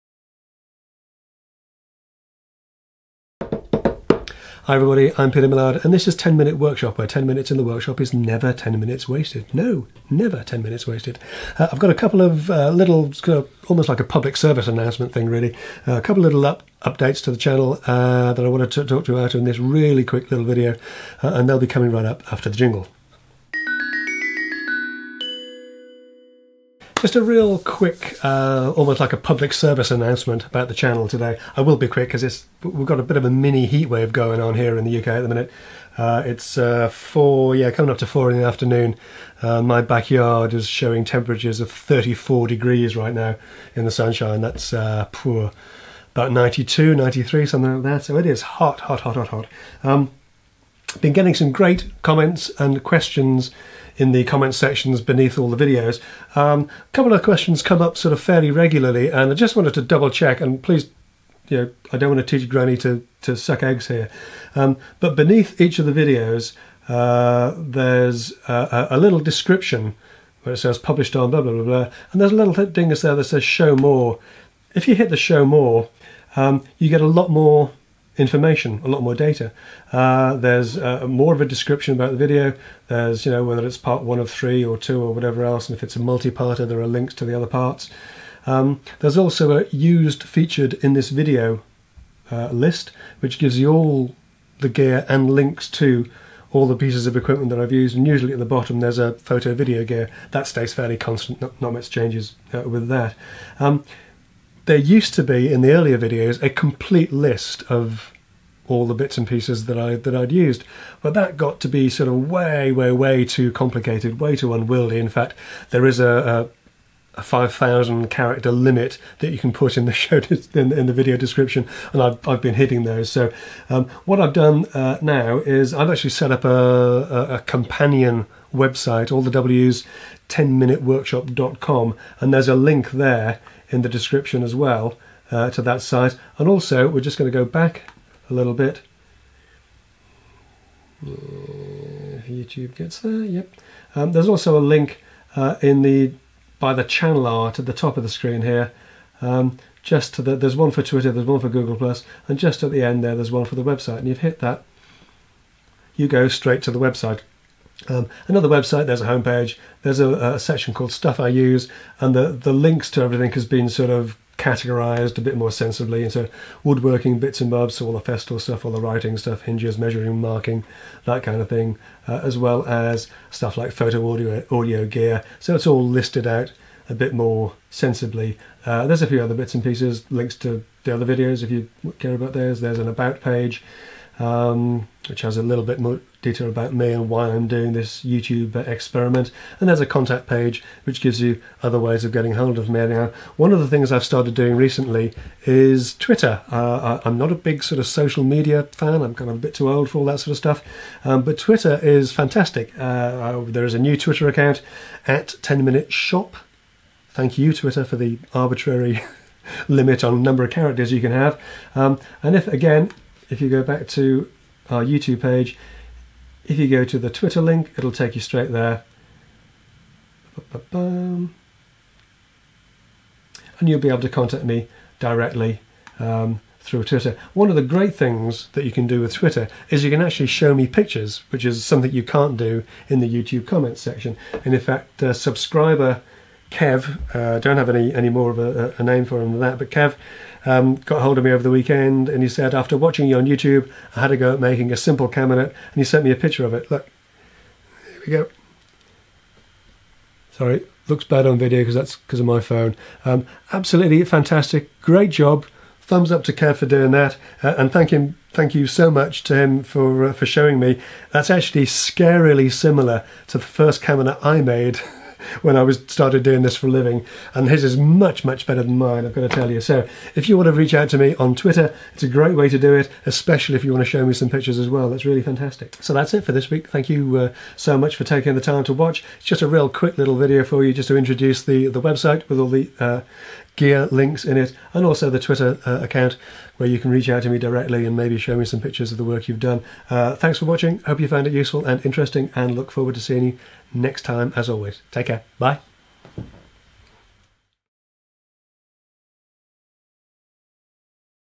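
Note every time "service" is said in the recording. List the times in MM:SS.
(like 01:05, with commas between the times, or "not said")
00:14, 00:29.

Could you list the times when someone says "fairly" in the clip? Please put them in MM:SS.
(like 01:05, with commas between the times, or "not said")
00:58, 01:40.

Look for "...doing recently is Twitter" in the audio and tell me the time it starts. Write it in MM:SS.
03:14.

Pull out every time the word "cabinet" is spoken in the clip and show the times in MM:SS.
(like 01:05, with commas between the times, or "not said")
04:05, 04:23.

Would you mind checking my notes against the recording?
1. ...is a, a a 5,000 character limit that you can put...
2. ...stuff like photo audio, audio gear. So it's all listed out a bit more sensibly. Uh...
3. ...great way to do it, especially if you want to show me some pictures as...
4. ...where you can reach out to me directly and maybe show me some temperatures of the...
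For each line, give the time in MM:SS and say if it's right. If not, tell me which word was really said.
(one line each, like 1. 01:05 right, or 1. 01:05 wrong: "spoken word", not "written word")
1. 01:55 right
2. 02:53 right
3. 04:32 right
4. 04:46 wrong: "pictures", not "temperatures".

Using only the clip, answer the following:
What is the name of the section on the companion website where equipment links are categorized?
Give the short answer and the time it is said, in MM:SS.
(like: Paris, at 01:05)
Stuff I Use, at 02:40.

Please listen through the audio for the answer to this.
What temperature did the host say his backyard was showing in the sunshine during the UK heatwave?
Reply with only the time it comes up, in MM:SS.
00:41.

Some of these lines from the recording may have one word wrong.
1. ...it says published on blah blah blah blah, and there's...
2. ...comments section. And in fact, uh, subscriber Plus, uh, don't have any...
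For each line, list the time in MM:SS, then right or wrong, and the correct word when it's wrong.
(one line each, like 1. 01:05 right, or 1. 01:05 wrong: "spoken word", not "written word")
1. 01:10 right
2. 03:53 wrong: "Kev", not "Plus".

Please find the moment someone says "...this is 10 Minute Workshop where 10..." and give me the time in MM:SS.
00:05.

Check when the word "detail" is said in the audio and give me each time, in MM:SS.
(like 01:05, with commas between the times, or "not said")
03:06.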